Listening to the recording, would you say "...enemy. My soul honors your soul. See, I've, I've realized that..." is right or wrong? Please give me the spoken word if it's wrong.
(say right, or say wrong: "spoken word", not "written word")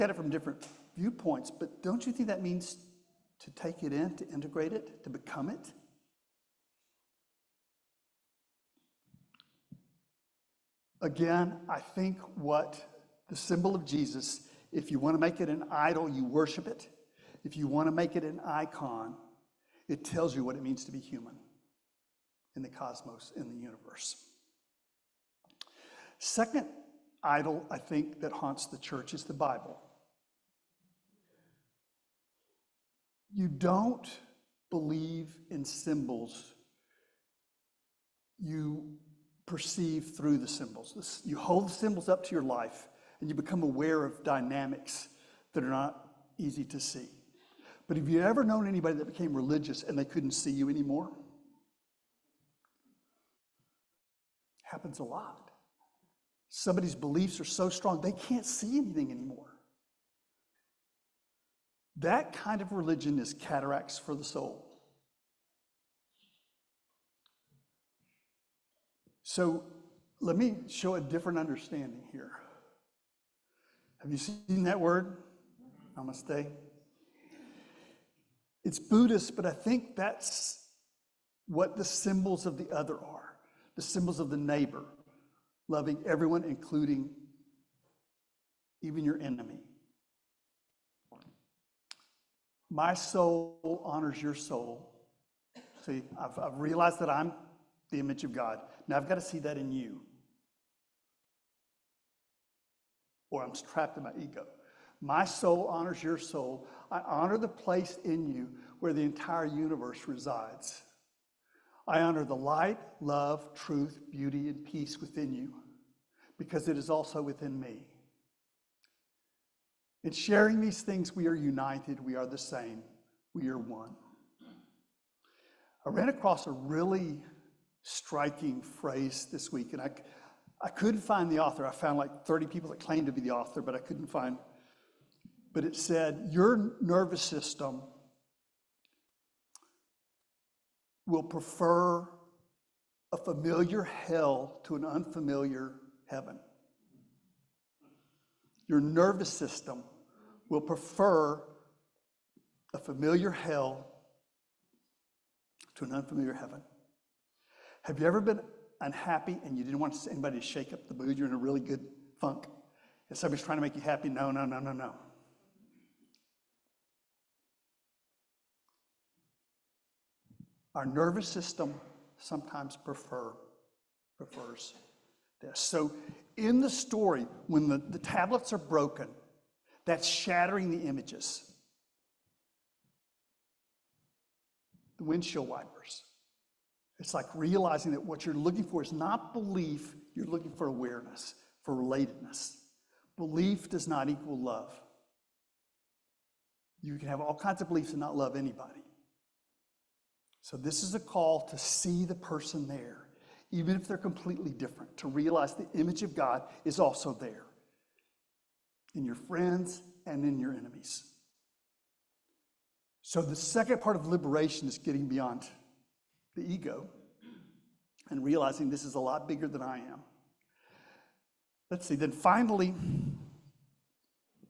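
right.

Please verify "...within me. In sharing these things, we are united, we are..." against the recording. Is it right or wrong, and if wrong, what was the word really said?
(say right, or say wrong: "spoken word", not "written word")
right.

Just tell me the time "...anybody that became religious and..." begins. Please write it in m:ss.
0:48.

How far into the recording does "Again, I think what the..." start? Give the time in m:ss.
0:11.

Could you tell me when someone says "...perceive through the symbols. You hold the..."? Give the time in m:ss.
0:39.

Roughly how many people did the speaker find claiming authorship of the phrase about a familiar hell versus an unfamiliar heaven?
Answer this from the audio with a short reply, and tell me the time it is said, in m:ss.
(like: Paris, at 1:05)
30, at 2:12.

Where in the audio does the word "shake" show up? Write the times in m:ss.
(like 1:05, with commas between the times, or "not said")
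2:40.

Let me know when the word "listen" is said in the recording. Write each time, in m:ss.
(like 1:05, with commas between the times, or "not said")
not said.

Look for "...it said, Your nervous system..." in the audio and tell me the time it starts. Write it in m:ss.
2:15.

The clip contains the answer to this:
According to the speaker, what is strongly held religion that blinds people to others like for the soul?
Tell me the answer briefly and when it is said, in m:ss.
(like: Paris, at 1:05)
Cataracts, at 1:03.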